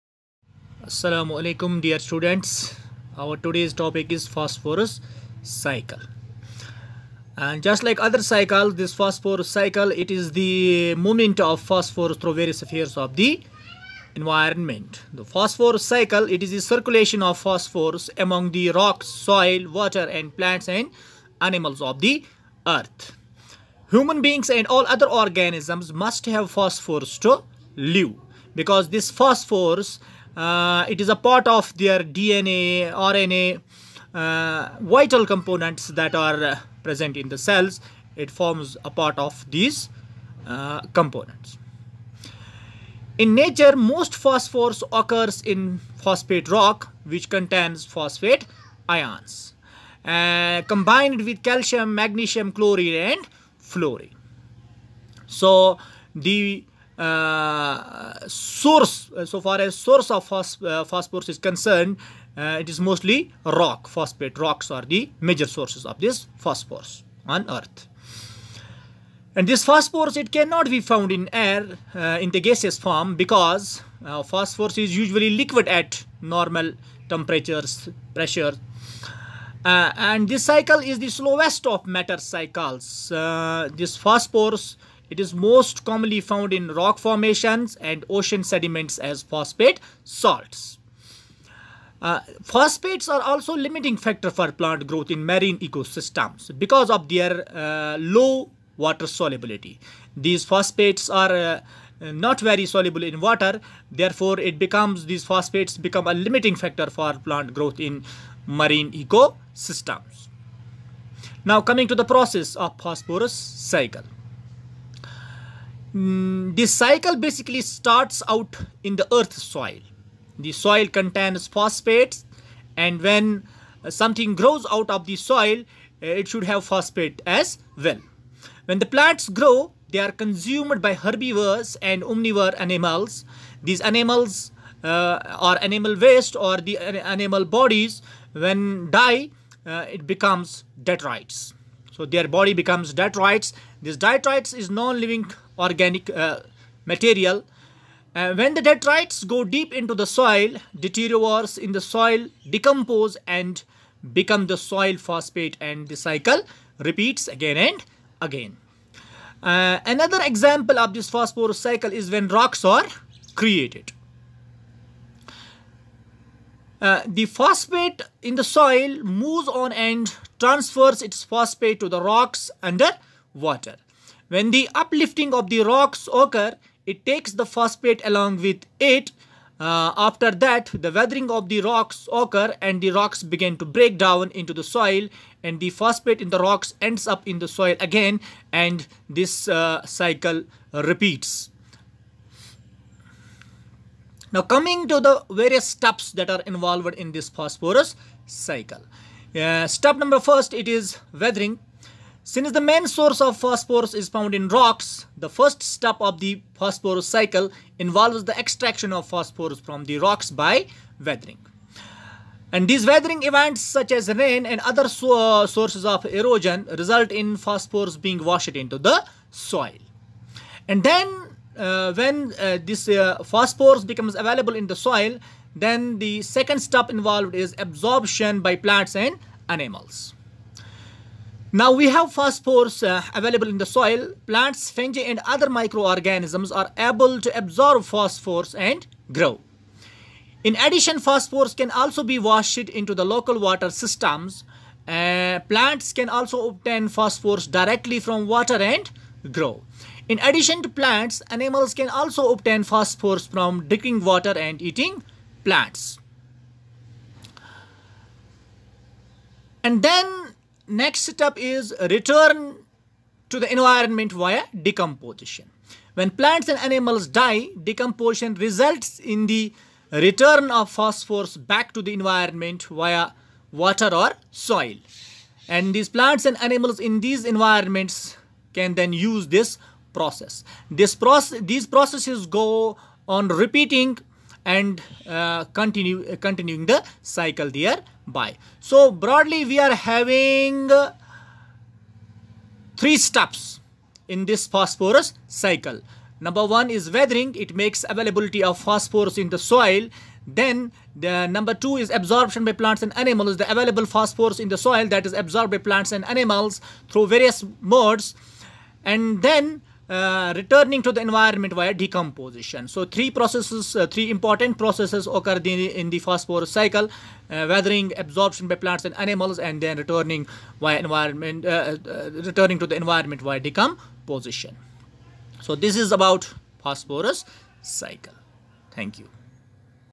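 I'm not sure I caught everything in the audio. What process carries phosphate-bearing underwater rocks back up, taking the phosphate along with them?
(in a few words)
Uplifting.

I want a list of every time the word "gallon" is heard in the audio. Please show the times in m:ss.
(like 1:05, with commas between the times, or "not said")
not said.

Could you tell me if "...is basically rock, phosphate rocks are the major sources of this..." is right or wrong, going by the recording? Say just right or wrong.
wrong.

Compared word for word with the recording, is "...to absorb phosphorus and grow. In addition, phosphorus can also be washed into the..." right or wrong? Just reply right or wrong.
right.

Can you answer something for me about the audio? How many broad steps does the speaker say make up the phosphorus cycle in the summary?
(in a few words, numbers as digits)
3.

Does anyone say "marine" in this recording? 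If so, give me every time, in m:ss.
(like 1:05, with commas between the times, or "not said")
1:35, 1:48.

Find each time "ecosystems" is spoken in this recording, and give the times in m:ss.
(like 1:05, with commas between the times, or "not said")
1:35, 1:48.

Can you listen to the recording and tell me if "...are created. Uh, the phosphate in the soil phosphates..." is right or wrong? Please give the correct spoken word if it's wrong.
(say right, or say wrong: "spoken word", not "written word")
wrong: "moves", not "phosphates".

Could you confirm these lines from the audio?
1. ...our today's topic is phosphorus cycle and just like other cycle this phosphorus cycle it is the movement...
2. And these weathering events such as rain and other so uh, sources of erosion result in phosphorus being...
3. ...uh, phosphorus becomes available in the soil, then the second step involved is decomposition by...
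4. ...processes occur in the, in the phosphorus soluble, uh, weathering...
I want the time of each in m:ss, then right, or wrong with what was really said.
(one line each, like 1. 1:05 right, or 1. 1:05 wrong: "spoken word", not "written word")
1. 0:03 right
2. 3:32 right
3. 3:42 wrong: "absorption", not "decomposition"
4. 5:14 wrong: "cycle", not "soluble".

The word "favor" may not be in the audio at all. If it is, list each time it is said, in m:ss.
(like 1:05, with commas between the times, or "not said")
not said.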